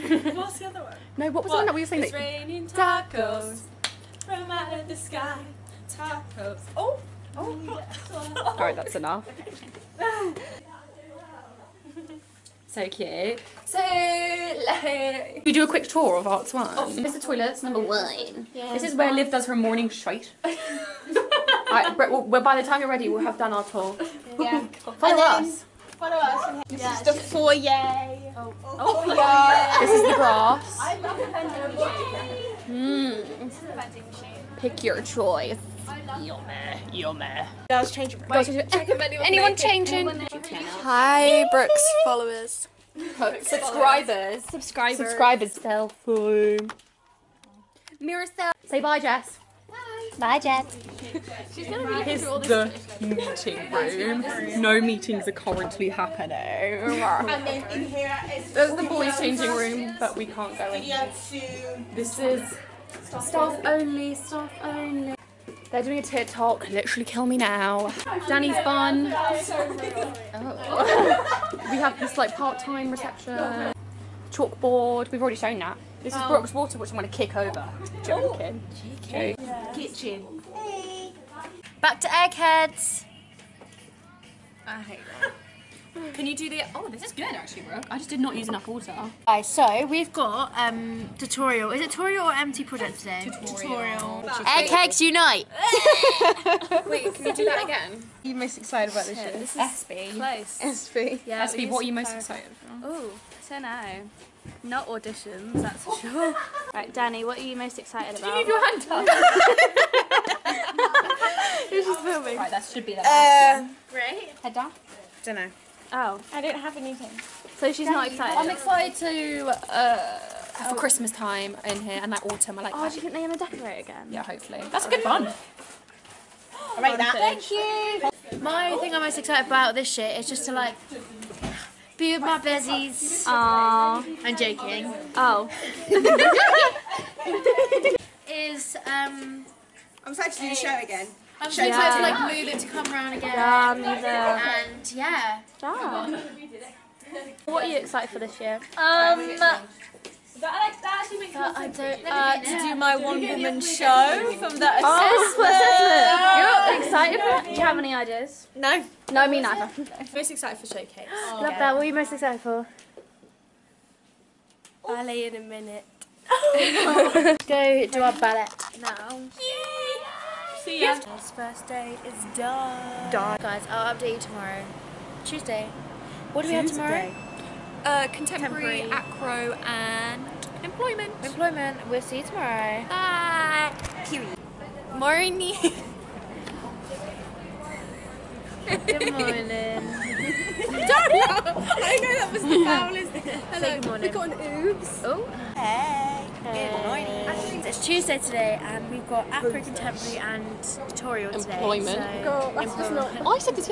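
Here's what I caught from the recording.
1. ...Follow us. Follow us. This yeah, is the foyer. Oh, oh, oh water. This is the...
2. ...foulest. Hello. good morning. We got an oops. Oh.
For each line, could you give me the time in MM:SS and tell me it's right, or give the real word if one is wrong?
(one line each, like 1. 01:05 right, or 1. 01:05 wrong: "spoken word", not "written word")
1. 00:24 wrong: "foyer", not "water"
2. 03:12 right.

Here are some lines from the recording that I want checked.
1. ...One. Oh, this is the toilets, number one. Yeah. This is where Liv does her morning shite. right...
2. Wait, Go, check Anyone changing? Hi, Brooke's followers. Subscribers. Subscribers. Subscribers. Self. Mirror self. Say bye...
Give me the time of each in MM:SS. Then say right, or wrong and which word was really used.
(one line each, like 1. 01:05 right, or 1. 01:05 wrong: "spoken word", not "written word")
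1. 00:16 right
2. 00:38 right.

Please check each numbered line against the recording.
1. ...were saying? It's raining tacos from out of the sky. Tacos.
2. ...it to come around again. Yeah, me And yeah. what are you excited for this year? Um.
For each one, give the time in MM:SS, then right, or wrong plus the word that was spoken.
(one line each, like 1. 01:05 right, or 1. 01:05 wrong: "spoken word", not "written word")
1. 00:01 right
2. 02:22 right.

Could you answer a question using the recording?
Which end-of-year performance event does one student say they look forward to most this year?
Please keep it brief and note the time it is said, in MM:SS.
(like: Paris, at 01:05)
Showcase, at 02:40.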